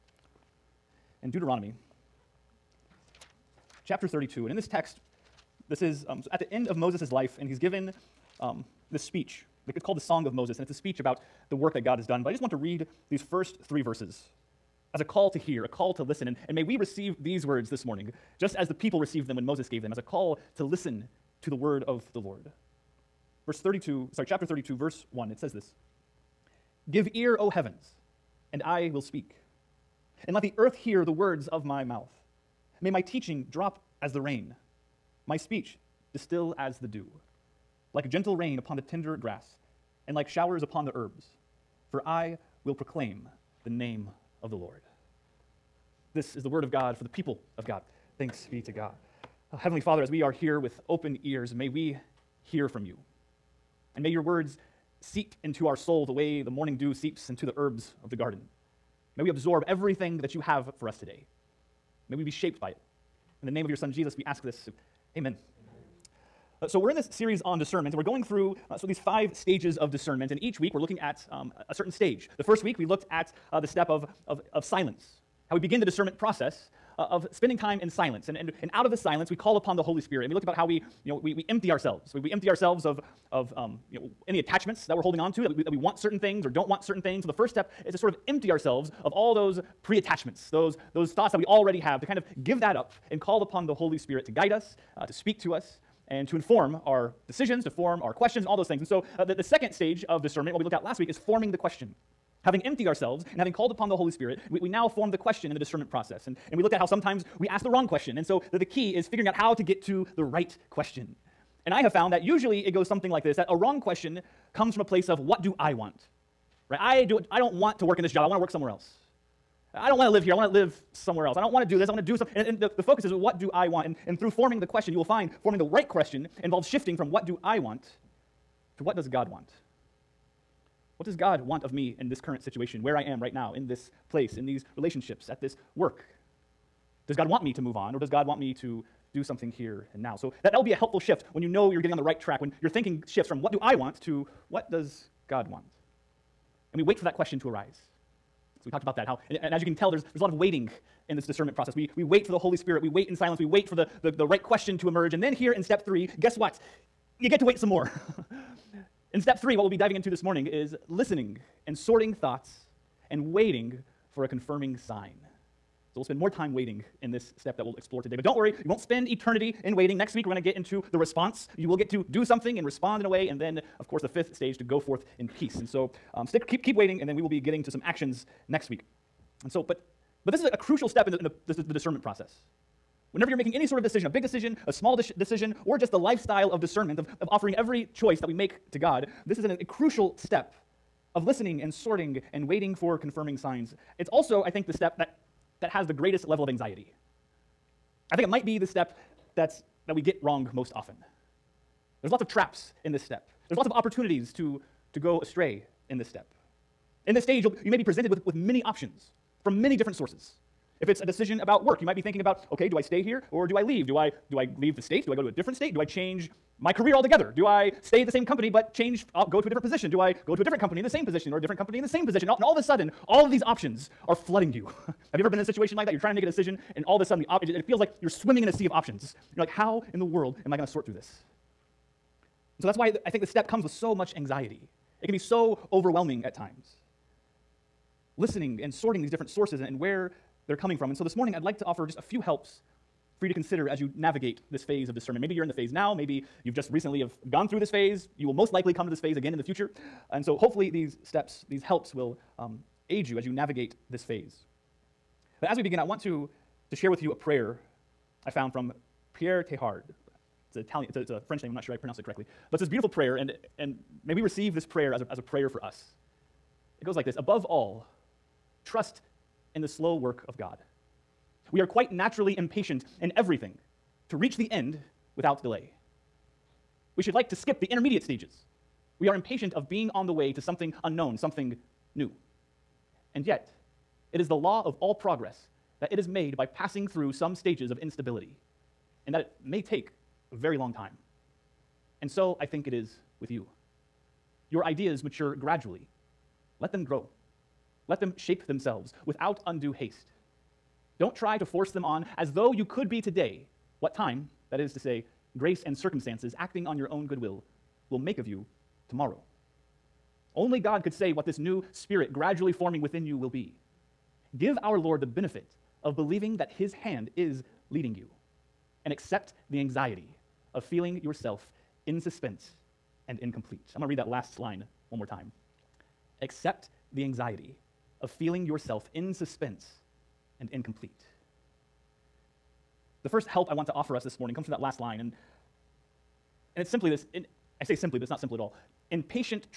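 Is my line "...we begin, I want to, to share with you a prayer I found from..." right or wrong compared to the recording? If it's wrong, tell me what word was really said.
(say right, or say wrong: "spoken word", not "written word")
right.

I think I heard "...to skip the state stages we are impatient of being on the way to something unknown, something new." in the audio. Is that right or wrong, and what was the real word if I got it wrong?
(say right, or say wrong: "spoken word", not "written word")
wrong: "intermediate", not "state".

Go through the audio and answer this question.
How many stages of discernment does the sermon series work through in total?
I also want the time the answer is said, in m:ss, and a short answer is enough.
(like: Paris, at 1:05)
5, at 1:08.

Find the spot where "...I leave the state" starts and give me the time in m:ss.
3:34.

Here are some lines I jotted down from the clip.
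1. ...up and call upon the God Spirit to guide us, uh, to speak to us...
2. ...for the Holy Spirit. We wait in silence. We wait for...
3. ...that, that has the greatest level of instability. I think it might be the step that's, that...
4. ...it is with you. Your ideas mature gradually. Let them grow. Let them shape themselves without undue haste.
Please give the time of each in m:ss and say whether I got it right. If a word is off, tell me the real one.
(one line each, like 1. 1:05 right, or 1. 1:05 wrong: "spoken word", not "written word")
1. 1:32 wrong: "Holy", not "God"
2. 2:32 right
3. 3:14 wrong: "anxiety", not "instability"
4. 4:52 right.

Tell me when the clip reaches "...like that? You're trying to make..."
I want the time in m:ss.
3:45.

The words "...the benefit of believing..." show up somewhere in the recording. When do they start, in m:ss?
5:15.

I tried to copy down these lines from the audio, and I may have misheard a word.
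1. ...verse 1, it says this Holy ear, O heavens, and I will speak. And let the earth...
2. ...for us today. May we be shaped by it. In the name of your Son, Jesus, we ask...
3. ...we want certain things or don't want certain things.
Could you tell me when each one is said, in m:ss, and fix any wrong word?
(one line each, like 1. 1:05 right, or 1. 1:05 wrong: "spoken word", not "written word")
1. 0:24 wrong: "Give", not "Holy"
2. 1:00 right
3. 1:25 right.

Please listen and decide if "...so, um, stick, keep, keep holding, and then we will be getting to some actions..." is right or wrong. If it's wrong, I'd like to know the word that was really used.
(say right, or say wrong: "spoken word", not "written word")
wrong: "waiting", not "holding".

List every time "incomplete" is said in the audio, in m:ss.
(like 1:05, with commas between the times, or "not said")
5:23, 5:30.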